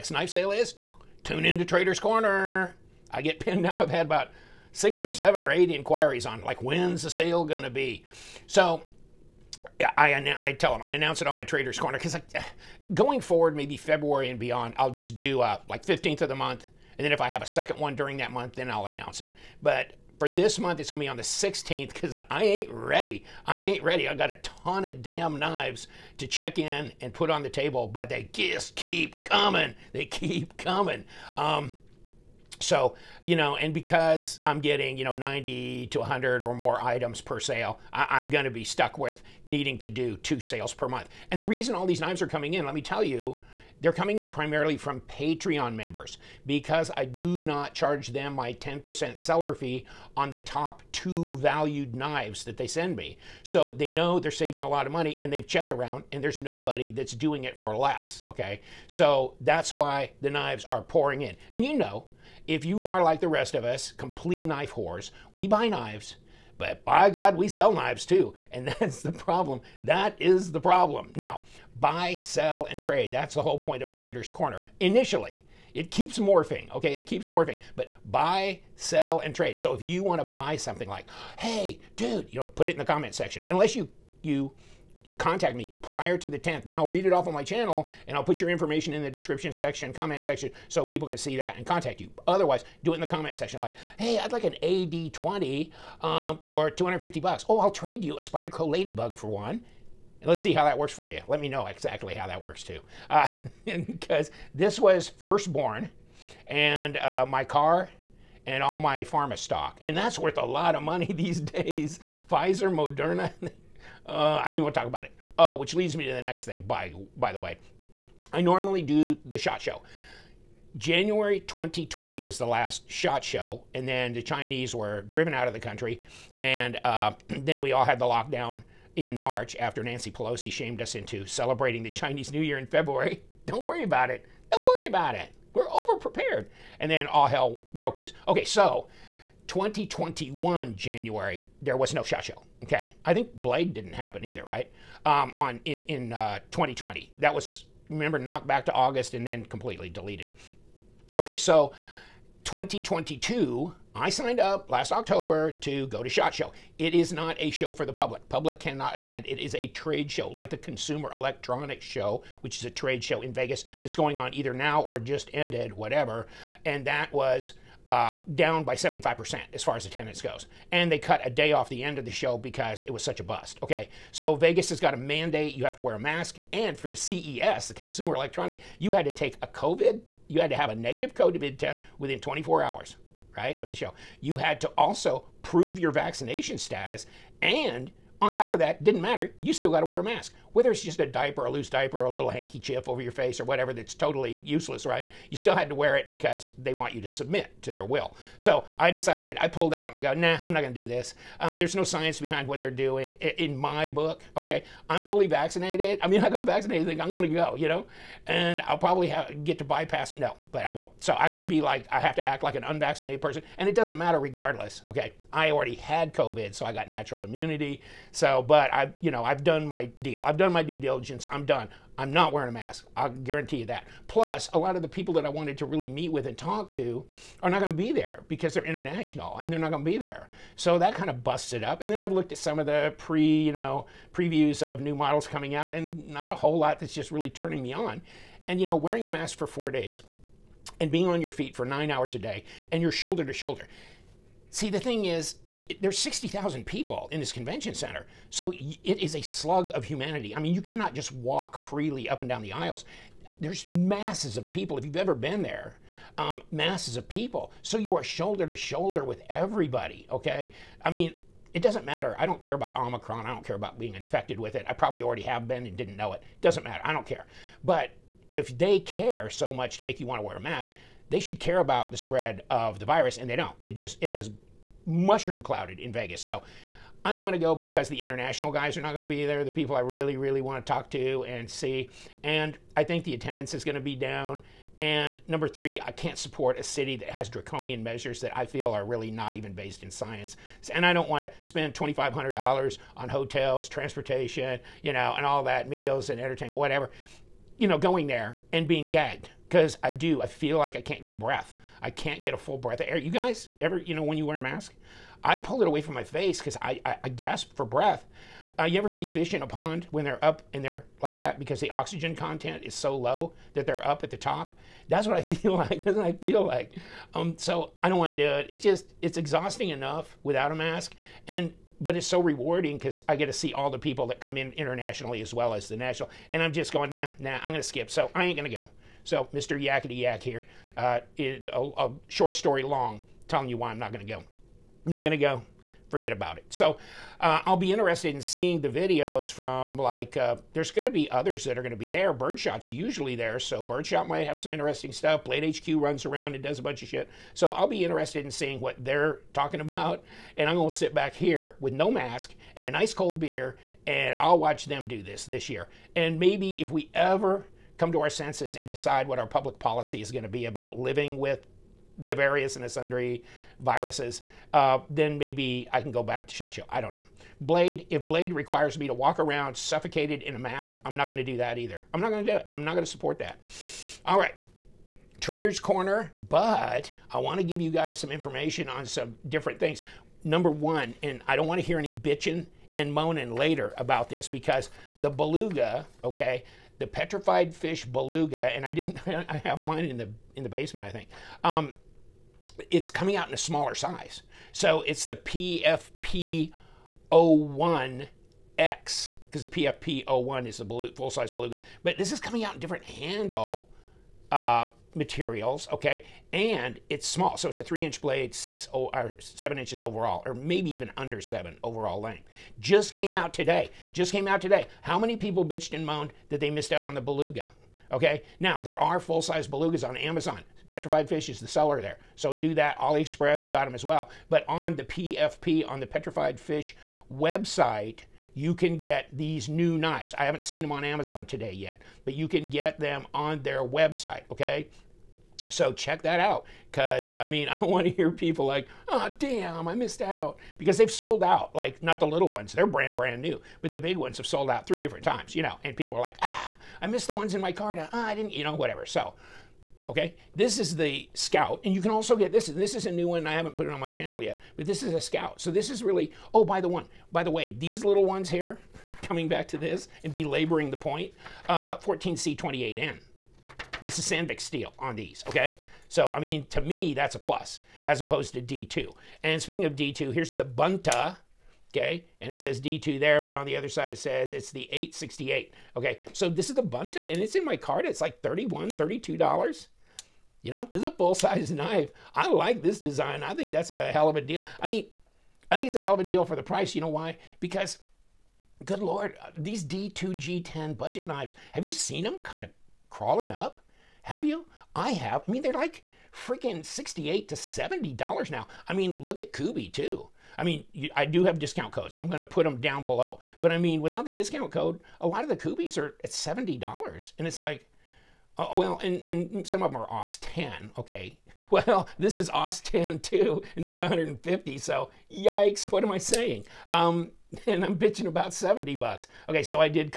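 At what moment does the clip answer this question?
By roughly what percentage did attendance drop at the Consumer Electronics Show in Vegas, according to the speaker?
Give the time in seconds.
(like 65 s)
168 s.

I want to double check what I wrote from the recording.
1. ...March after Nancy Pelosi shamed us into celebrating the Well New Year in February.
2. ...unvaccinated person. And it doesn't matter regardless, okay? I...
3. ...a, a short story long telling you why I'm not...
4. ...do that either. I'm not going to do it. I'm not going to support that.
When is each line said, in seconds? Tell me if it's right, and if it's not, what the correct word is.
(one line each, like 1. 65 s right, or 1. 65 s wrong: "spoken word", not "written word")
1. 129 s wrong: "Chinese", not "Well"
2. 212 s right
3. 331 s right
4. 371 s right.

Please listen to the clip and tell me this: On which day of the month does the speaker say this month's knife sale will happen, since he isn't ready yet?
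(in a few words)
16th.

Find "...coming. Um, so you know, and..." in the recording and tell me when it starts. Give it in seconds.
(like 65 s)
30 s.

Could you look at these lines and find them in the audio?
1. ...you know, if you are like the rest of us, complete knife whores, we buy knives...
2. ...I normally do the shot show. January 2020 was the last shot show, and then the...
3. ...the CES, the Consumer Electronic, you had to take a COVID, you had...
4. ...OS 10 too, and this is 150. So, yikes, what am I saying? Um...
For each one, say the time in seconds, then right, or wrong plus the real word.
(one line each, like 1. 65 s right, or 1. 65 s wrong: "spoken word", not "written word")
1. 61 s right
2. 118 s right
3. 176 s right
4. 512 s right.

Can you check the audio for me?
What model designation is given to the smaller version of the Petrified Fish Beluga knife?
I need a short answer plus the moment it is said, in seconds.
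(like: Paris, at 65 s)
PFP01X, at 395 s.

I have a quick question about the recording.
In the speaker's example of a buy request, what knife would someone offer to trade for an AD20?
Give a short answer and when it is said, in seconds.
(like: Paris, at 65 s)
Spyderco Ladybug, at 98 s.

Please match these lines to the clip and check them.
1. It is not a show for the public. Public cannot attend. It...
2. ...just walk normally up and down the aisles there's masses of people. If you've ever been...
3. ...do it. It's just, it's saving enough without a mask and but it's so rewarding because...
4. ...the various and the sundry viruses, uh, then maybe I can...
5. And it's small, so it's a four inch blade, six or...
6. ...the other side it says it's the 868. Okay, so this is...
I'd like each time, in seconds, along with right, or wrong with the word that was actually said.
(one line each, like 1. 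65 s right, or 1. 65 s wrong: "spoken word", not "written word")
1. 156 s right
2. 250 s wrong: "freely", not "normally"
3. 318 s wrong: "exhausting", not "saving"
4. 361 s right
5. 406 s wrong: "three", not "four"
6. 473 s right.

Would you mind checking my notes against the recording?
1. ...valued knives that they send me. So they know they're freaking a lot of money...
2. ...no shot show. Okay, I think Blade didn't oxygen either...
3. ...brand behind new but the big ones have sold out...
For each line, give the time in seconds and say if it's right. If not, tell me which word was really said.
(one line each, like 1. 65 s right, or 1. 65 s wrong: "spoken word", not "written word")
1. 51 s wrong: "saving", not "freaking"
2. 141 s wrong: "happen", not "oxygen"
3. 442 s wrong: "brand", not "behind".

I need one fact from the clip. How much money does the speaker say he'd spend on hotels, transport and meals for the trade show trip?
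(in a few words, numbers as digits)
$2,500.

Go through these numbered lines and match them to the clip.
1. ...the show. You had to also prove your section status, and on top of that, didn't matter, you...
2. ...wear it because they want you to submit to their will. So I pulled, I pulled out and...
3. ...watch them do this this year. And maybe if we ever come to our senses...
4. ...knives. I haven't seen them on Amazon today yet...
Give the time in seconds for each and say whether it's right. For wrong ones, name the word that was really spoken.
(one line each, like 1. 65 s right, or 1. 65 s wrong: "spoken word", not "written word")
1. 183 s wrong: "vaccination", not "section"
2. 195 s wrong: "decided", not "pulled"
3. 354 s right
4. 429 s right.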